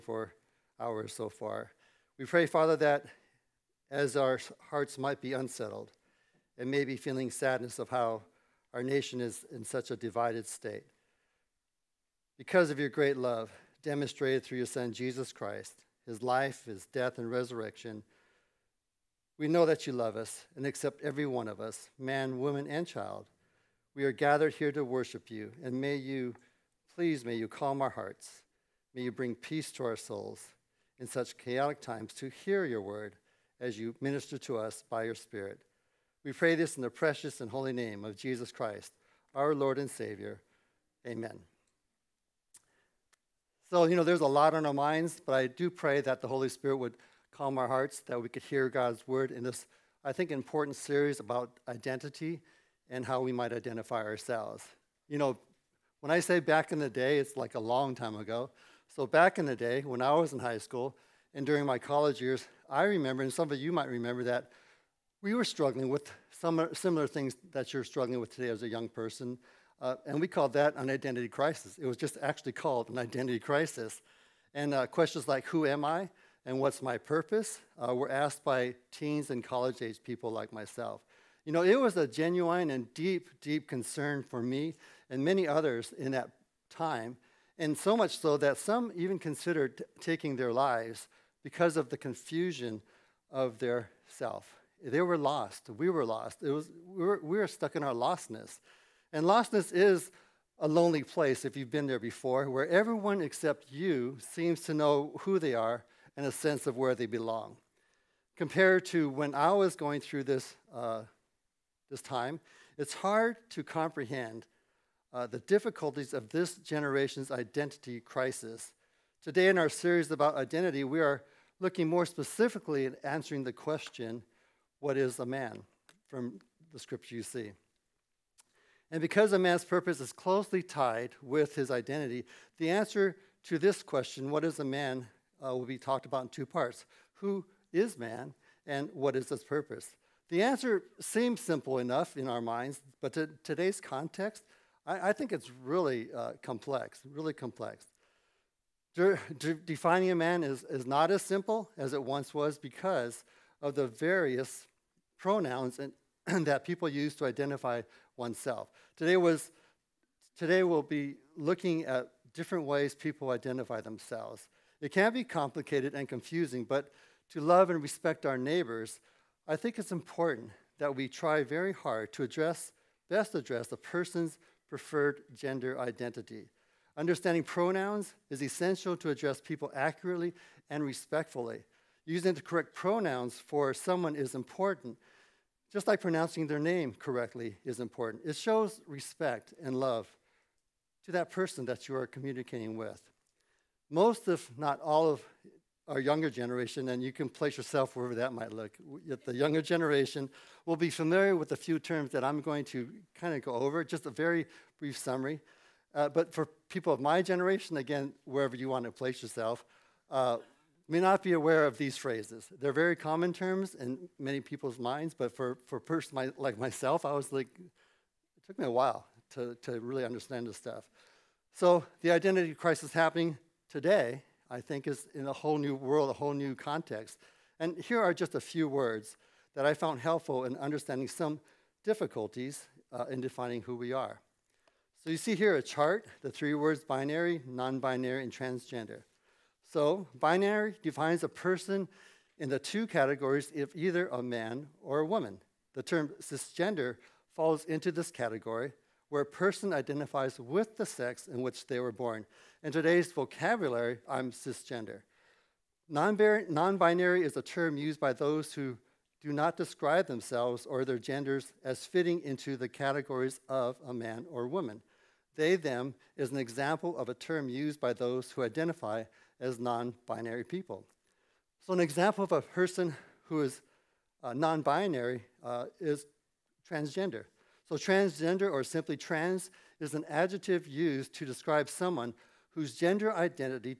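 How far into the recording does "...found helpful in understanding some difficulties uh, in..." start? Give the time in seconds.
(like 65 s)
229 s.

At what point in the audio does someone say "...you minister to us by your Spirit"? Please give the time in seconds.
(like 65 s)
33 s.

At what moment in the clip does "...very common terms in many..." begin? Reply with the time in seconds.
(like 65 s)
212 s.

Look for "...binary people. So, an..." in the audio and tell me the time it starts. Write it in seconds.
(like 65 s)
270 s.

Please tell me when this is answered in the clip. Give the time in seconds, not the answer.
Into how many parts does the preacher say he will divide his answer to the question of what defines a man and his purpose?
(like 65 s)
136 s.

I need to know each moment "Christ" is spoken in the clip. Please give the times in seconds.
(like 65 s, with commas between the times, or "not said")
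15 s, 38 s.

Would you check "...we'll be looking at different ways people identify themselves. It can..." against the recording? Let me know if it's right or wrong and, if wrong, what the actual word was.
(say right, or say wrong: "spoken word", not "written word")
right.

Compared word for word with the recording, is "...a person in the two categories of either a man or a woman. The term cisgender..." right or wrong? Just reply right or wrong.
right.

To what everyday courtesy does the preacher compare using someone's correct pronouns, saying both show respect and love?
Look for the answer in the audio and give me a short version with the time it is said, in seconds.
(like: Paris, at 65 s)
Pronouncing their name correctly, at 186 s.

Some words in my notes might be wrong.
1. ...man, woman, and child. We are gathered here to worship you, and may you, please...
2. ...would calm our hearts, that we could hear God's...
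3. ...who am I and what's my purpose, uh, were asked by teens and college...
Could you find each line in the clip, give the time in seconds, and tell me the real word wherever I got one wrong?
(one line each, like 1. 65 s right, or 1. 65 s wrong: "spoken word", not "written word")
1. 21 s right
2. 46 s right
3. 75 s right.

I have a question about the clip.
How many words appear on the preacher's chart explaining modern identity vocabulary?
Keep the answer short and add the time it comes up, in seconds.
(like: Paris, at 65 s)
3, at 236 s.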